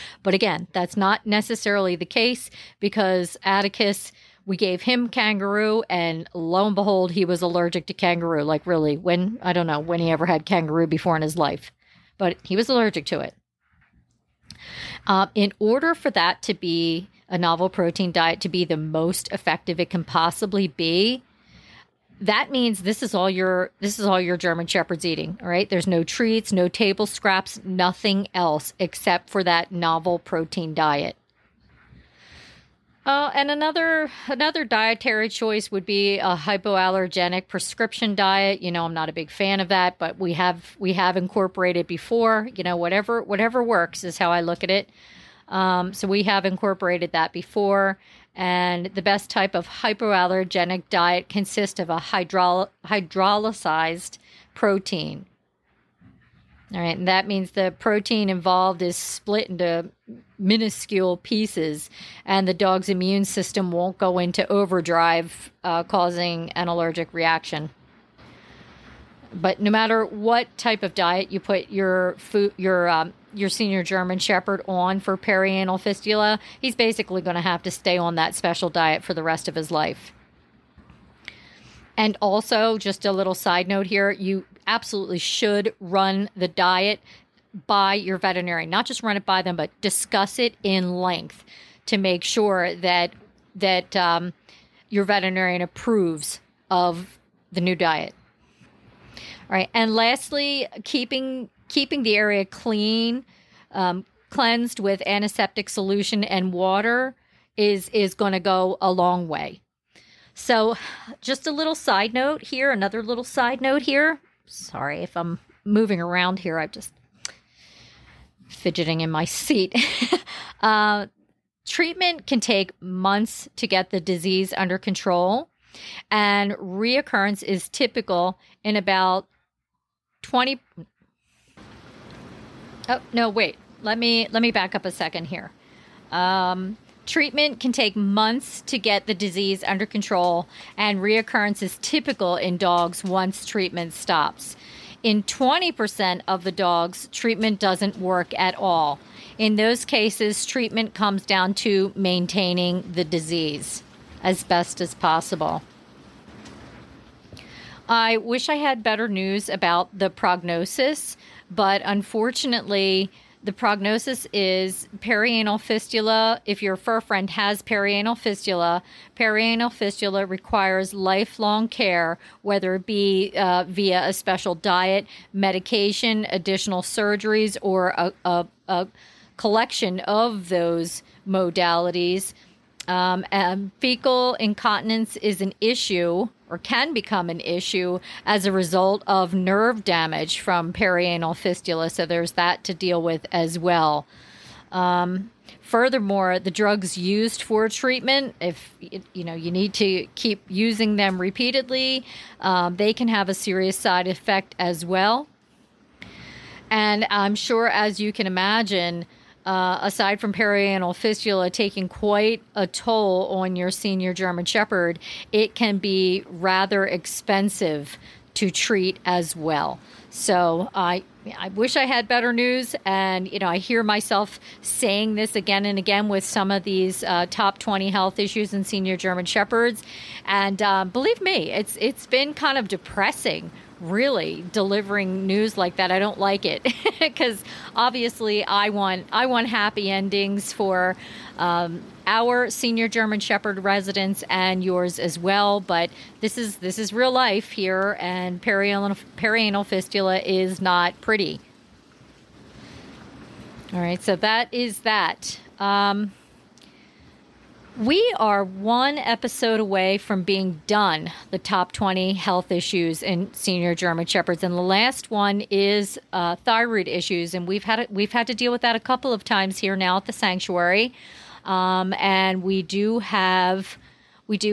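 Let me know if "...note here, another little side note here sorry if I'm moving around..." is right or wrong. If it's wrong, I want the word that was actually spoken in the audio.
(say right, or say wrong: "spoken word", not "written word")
right.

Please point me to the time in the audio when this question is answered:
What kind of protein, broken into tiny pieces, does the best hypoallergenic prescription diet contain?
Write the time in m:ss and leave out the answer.
0:52.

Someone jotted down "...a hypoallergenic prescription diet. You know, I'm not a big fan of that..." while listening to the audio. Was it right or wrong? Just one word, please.
right.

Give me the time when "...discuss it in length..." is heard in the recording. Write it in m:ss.
1:29.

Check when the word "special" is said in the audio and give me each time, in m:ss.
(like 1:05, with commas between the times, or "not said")
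1:18, 2:54.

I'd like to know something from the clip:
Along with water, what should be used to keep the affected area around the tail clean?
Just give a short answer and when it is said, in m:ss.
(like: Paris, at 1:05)
Antiseptic solution, at 1:45.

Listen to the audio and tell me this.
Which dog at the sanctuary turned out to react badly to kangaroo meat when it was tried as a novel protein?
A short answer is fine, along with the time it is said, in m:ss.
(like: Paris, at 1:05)
Atticus, at 0:03.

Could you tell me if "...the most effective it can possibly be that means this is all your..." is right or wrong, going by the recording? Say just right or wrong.
right.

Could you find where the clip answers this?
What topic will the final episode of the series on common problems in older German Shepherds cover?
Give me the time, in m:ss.
4:26.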